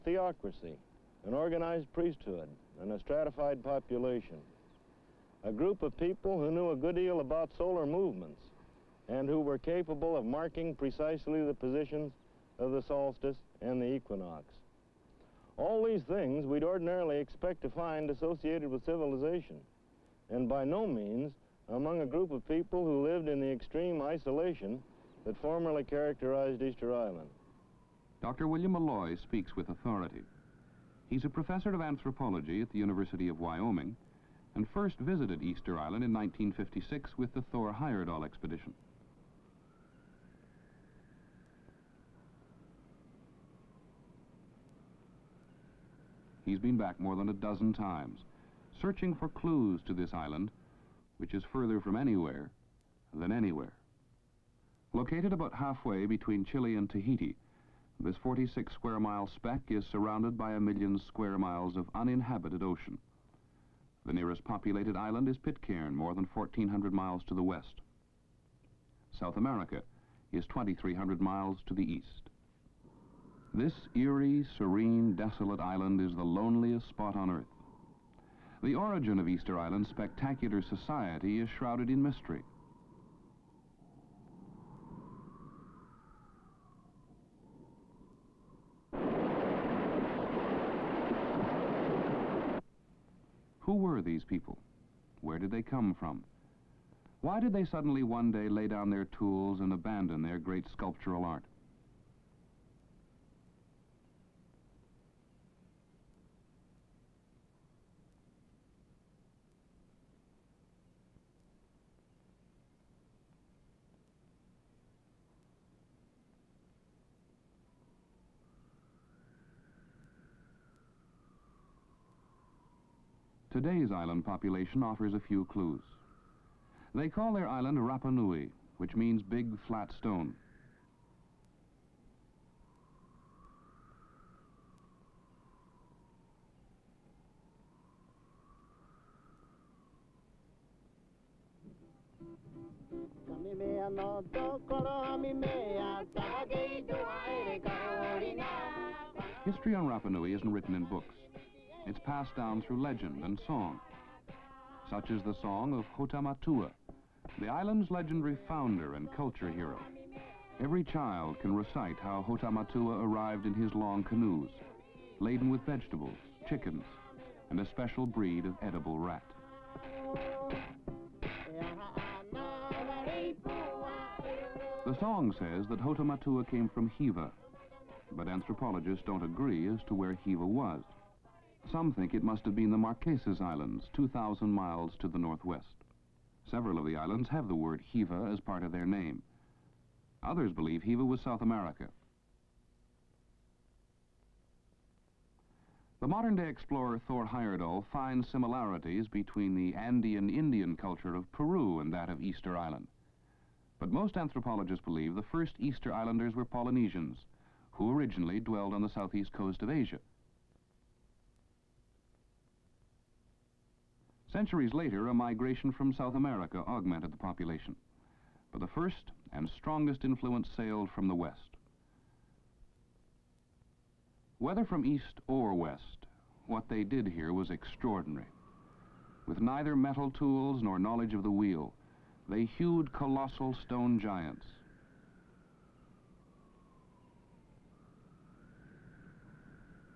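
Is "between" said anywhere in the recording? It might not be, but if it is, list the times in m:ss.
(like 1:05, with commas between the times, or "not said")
0:56, 3:19.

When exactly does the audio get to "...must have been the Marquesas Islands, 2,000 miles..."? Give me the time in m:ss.
3:02.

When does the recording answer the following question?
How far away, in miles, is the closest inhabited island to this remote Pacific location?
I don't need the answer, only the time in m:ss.
1:06.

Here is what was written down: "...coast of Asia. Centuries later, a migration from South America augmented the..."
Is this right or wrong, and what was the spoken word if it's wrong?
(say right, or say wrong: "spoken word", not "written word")
right.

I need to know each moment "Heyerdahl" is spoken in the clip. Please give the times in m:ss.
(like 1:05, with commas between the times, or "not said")
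0:37, 3:17.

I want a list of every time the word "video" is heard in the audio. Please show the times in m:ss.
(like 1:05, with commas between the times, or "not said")
not said.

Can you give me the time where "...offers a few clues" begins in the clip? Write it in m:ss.
2:04.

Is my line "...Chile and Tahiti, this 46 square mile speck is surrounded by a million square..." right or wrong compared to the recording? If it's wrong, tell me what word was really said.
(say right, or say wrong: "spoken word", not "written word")
right.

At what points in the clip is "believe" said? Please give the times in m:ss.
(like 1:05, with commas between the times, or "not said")
3:10, 3:24.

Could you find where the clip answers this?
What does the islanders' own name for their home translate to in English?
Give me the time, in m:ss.
2:09.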